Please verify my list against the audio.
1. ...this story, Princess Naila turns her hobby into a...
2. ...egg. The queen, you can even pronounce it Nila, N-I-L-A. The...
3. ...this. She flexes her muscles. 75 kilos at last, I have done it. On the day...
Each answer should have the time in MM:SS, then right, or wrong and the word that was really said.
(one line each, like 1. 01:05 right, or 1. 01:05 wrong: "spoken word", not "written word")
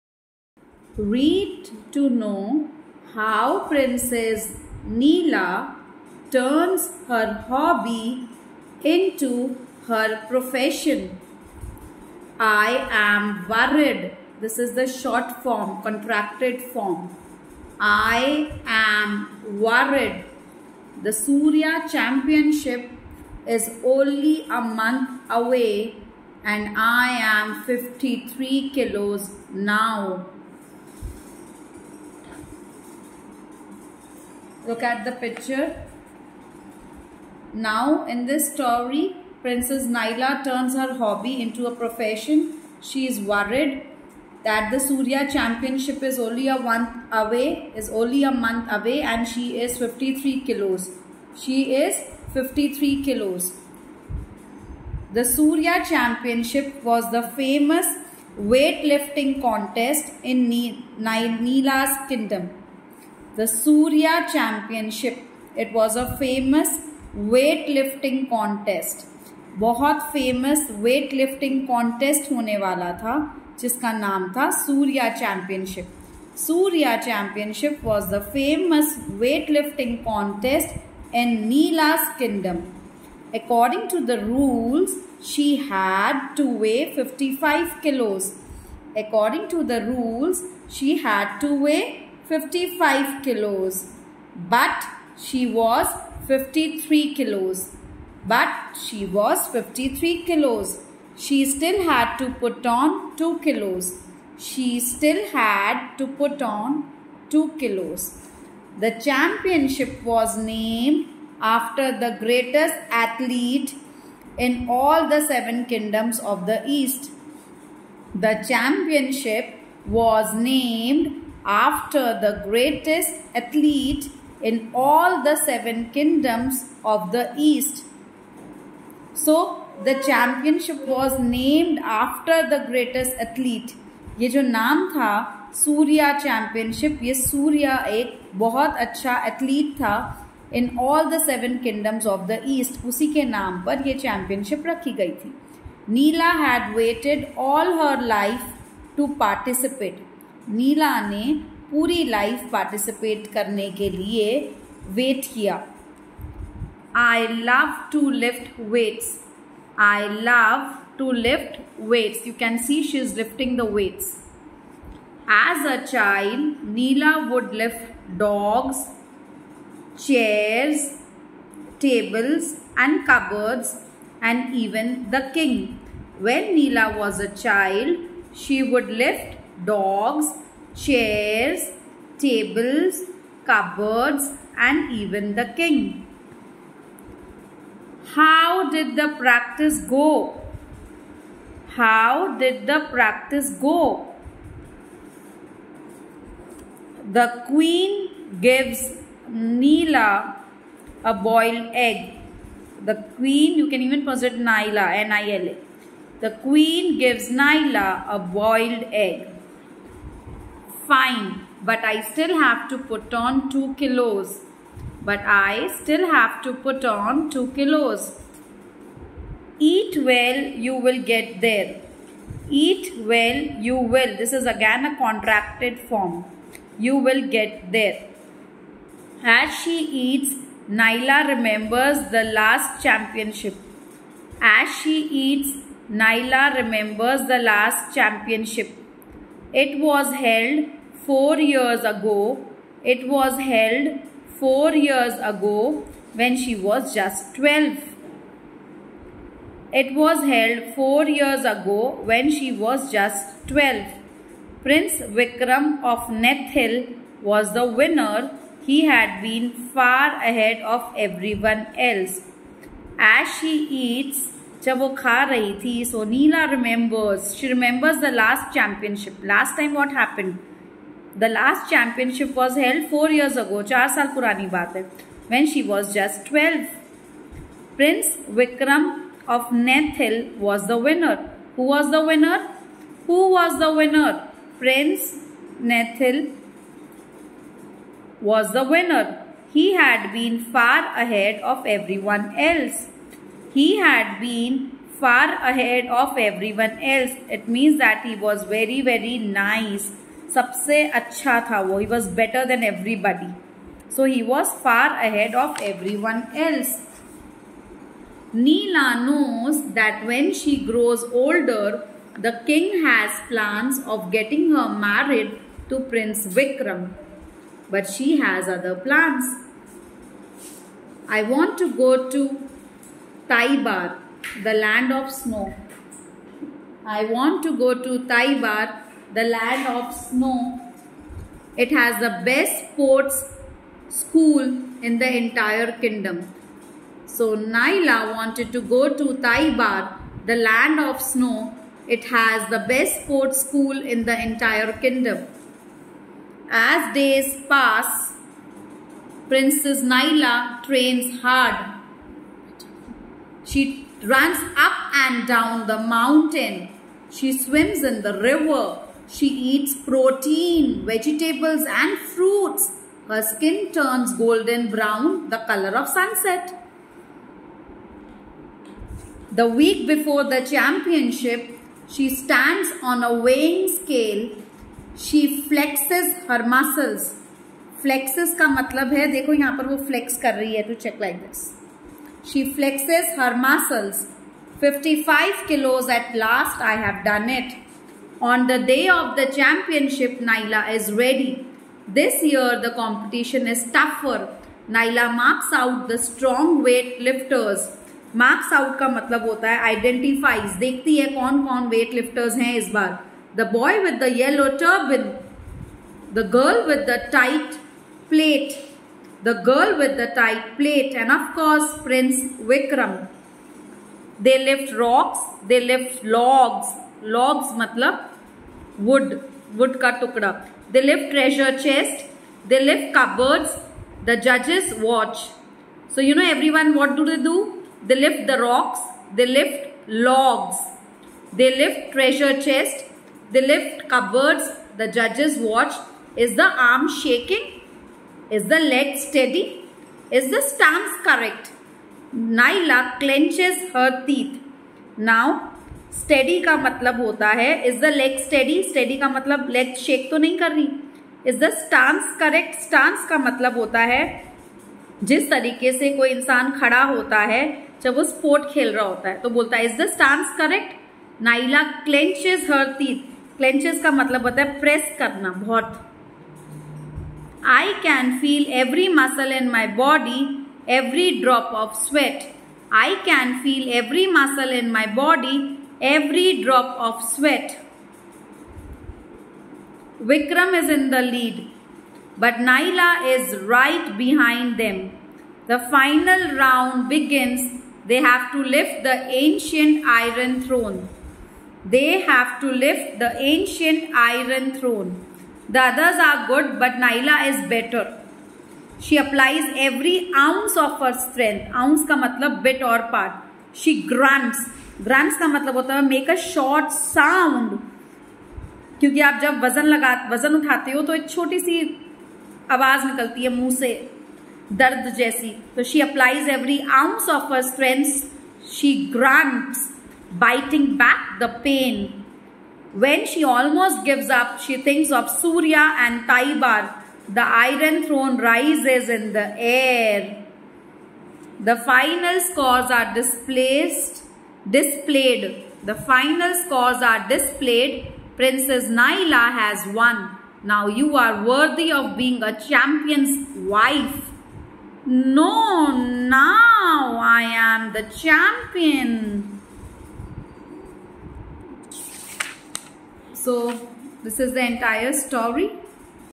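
1. 00:38 right
2. 03:21 right
3. 06:21 wrong: "55", not "75".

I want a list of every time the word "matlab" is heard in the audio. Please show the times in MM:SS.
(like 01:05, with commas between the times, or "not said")
06:18, 06:38, 06:57.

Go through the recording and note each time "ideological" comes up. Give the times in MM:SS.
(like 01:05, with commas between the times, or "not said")
not said.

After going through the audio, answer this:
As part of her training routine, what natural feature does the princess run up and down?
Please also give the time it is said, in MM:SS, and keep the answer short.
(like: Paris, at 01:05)
the mountain, at 05:55.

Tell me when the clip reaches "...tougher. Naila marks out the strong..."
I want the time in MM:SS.
06:33.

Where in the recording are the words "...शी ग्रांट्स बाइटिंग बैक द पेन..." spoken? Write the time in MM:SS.
08:38.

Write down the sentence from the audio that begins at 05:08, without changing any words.
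Neela knows that when she grows older, the king has plans of getting her married to Prince Vikram.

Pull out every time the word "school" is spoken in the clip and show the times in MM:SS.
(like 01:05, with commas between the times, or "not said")
05:33, 05:43.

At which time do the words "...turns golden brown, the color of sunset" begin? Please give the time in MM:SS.
06:03.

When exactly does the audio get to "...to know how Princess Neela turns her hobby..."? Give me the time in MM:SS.
00:01.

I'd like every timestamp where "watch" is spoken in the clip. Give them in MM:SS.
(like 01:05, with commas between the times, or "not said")
07:04, 07:15.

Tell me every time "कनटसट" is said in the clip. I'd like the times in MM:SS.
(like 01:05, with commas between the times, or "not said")
01:11, 01:20.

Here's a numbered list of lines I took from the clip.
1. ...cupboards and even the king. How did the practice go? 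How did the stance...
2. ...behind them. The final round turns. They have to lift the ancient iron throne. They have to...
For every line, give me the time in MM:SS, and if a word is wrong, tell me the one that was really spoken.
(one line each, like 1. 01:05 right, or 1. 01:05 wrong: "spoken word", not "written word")
1. 03:03 wrong: "practice", not "stance"
2. 08:03 wrong: "begins", not "turns".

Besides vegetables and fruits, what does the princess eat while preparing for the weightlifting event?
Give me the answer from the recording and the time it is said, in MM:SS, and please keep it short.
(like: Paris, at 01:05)
protein, at 05:59.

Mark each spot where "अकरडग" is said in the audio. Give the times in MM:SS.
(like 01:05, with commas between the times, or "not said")
01:23, 01:29.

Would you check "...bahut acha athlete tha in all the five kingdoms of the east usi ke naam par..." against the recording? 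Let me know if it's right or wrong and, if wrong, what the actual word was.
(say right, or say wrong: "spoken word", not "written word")
wrong: "seven", not "five".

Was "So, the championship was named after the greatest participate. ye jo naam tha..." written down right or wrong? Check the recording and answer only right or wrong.
wrong.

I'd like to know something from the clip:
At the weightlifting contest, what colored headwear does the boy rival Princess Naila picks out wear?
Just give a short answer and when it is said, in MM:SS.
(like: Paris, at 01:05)
yellow turban, at 06:44.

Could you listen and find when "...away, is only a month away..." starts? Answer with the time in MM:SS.
00:47.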